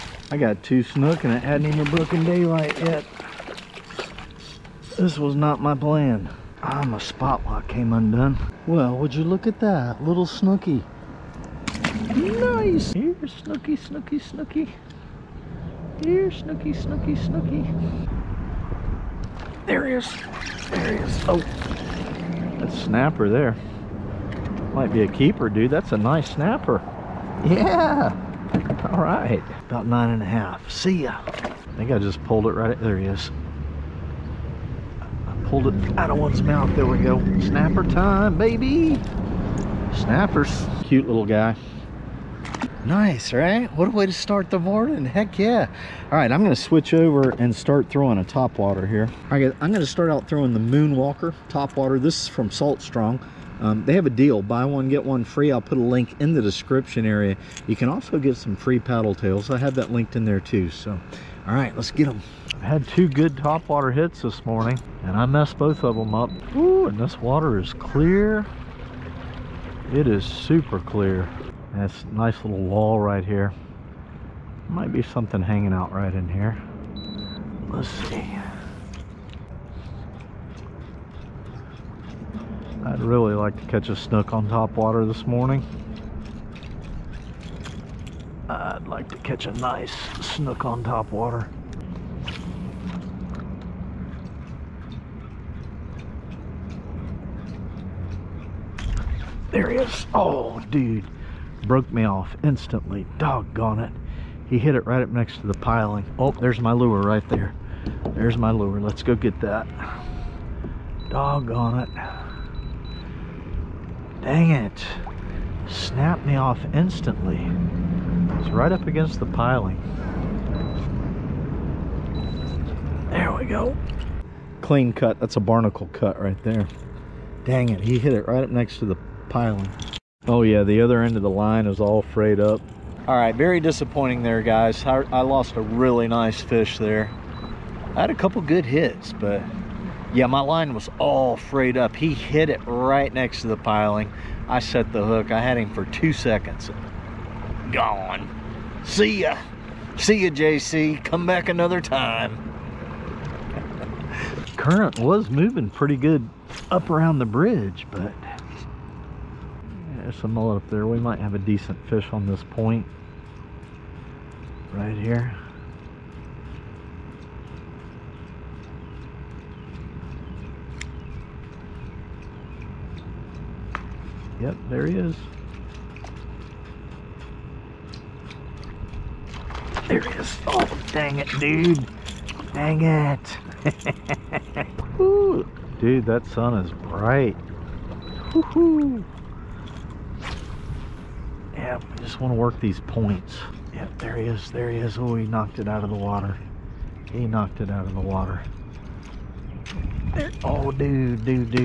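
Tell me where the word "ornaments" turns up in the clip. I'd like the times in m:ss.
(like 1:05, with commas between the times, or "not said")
not said.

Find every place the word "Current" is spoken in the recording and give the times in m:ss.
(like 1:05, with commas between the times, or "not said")
2:34.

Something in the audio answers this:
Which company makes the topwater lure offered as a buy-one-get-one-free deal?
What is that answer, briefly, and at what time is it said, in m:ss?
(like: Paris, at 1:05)
Salt Strong, at 0:52.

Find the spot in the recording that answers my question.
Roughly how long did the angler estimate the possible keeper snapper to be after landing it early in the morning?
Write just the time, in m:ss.
0:29.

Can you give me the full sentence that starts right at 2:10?
Oh yeah, the other end of the line is all frayed up.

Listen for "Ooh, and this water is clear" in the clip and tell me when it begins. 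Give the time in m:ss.
1:06.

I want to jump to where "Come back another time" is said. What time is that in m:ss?
2:31.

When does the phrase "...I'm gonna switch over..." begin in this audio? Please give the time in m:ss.
0:46.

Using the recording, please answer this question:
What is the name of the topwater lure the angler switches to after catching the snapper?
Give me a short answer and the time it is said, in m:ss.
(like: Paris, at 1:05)
Moonwalker, at 0:50.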